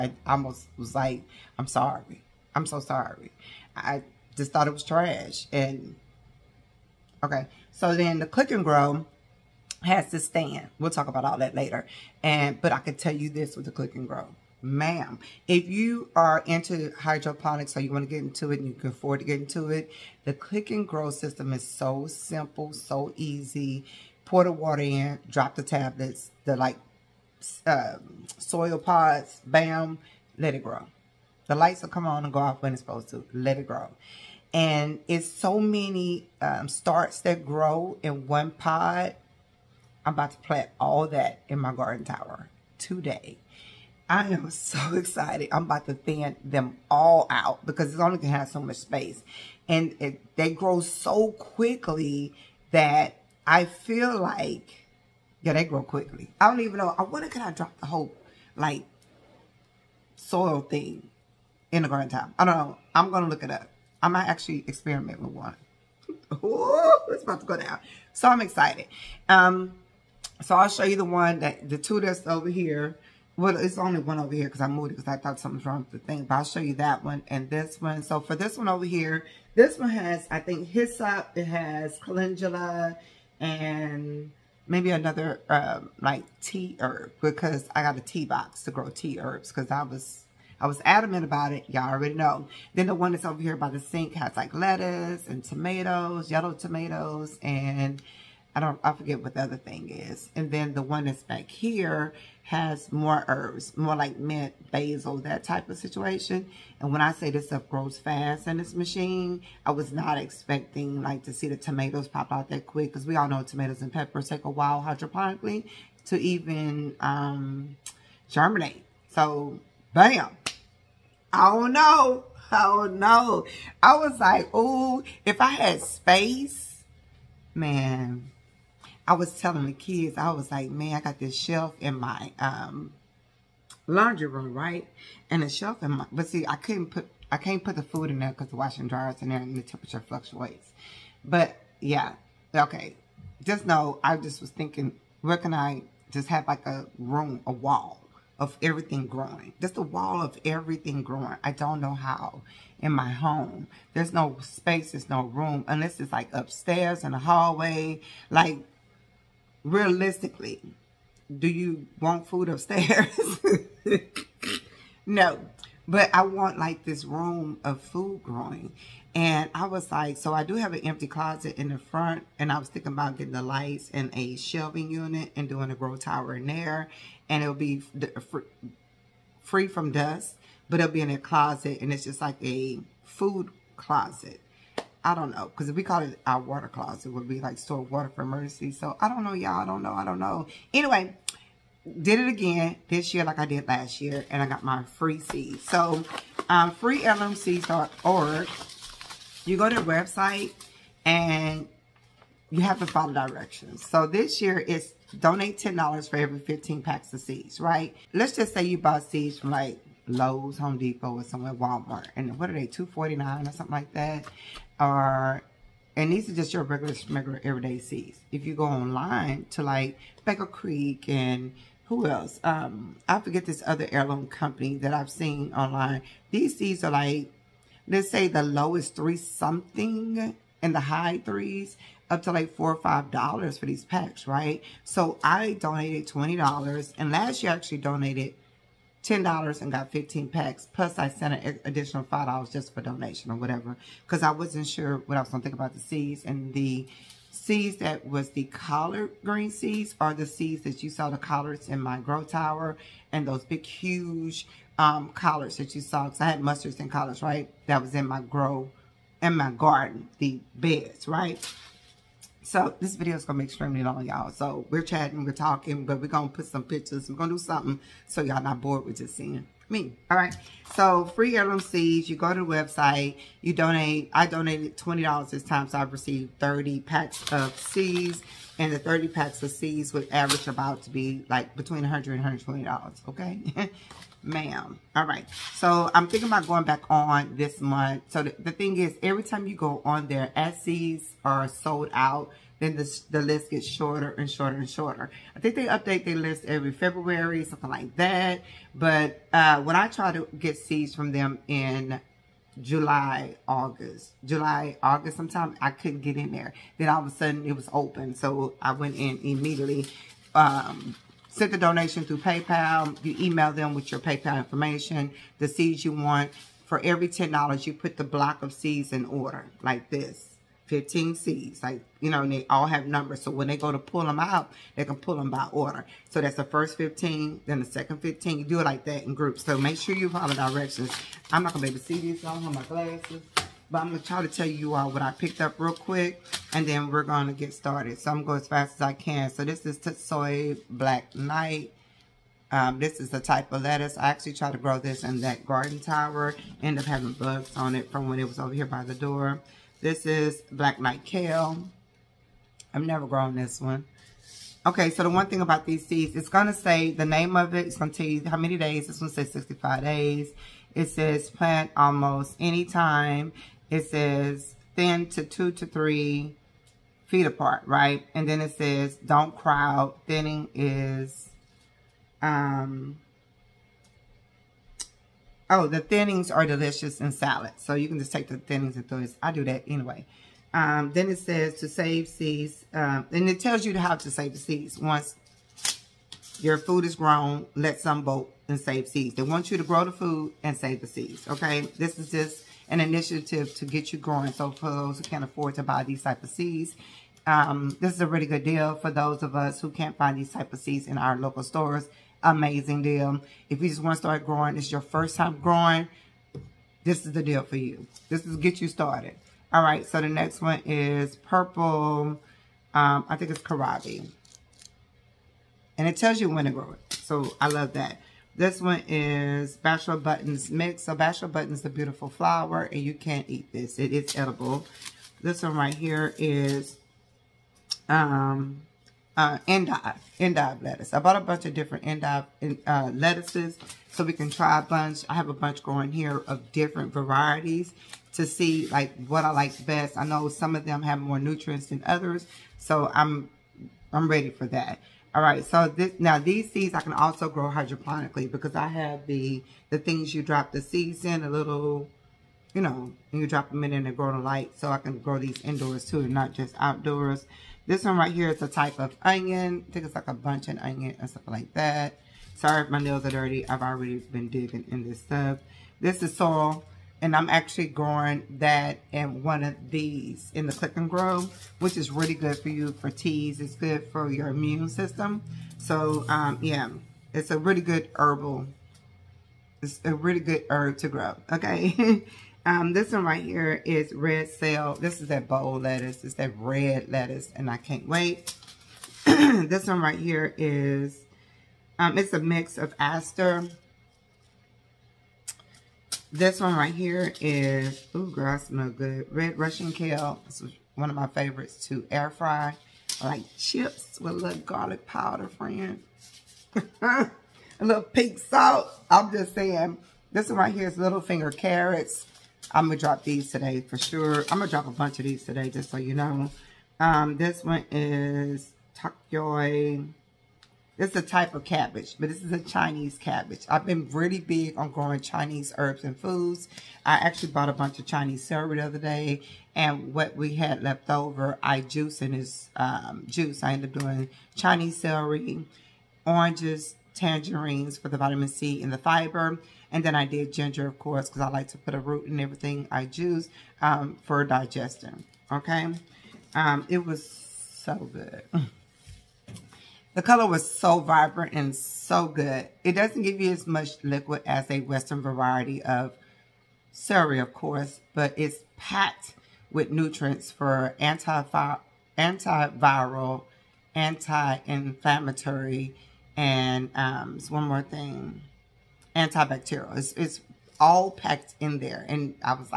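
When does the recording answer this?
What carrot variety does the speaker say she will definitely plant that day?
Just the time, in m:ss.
8:30.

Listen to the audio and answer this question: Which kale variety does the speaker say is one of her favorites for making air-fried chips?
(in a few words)
Red Russian kale.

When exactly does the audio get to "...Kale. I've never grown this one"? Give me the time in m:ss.
5:51.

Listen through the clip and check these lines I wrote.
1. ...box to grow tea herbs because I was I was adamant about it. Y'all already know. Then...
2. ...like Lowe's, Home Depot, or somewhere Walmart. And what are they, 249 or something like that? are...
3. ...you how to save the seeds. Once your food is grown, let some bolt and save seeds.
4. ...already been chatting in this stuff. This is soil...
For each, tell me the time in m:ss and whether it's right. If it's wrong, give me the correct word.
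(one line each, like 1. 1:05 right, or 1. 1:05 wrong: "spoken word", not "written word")
1. 1:28 right
2. 3:29 right
3. 6:23 right
4. 7:43 wrong: "digging", not "chatting".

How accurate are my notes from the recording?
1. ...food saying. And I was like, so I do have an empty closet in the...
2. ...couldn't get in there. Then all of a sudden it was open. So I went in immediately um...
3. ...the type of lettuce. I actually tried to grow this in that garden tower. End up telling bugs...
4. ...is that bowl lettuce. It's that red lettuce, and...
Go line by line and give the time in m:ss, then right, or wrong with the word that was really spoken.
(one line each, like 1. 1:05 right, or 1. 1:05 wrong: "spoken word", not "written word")
1. 2:47 wrong: "growing", not "saying"
2. 5:05 right
3. 5:43 wrong: "having", not "telling"
4. 8:05 right.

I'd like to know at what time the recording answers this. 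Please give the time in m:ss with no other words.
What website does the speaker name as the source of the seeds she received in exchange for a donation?
3:16.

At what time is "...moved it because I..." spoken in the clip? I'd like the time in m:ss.
1:14.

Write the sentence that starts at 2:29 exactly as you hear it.
Just a wall of everything growing.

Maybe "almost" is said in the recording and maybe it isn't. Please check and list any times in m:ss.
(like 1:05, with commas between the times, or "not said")
0:00, 6:01.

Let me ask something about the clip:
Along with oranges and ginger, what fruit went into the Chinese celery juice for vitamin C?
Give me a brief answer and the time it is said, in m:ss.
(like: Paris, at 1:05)
tangerines, at 8:56.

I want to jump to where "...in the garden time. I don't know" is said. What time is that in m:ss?
1:01.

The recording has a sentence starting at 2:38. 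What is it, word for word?
Like, realistically, do you want food upstairs?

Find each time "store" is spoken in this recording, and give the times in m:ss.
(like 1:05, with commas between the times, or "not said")
3:07, 6:41.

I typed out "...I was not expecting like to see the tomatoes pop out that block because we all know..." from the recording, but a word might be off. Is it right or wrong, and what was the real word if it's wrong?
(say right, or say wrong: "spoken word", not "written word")
wrong: "quick", not "block".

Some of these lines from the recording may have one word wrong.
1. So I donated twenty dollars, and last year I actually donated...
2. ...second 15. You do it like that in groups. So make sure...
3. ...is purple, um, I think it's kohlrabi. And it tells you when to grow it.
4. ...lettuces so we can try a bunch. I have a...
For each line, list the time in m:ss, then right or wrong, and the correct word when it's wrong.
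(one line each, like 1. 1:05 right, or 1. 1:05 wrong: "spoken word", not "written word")
1. 3:54 right
2. 5:27 right
3. 6:50 right
4. 7:12 right.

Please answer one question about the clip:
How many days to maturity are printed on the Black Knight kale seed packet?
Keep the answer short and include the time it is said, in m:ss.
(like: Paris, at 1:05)
65, at 5:59.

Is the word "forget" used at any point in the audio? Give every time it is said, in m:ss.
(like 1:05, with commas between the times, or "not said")
1:38, 3:43.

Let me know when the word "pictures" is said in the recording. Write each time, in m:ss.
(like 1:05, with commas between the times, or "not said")
4:26.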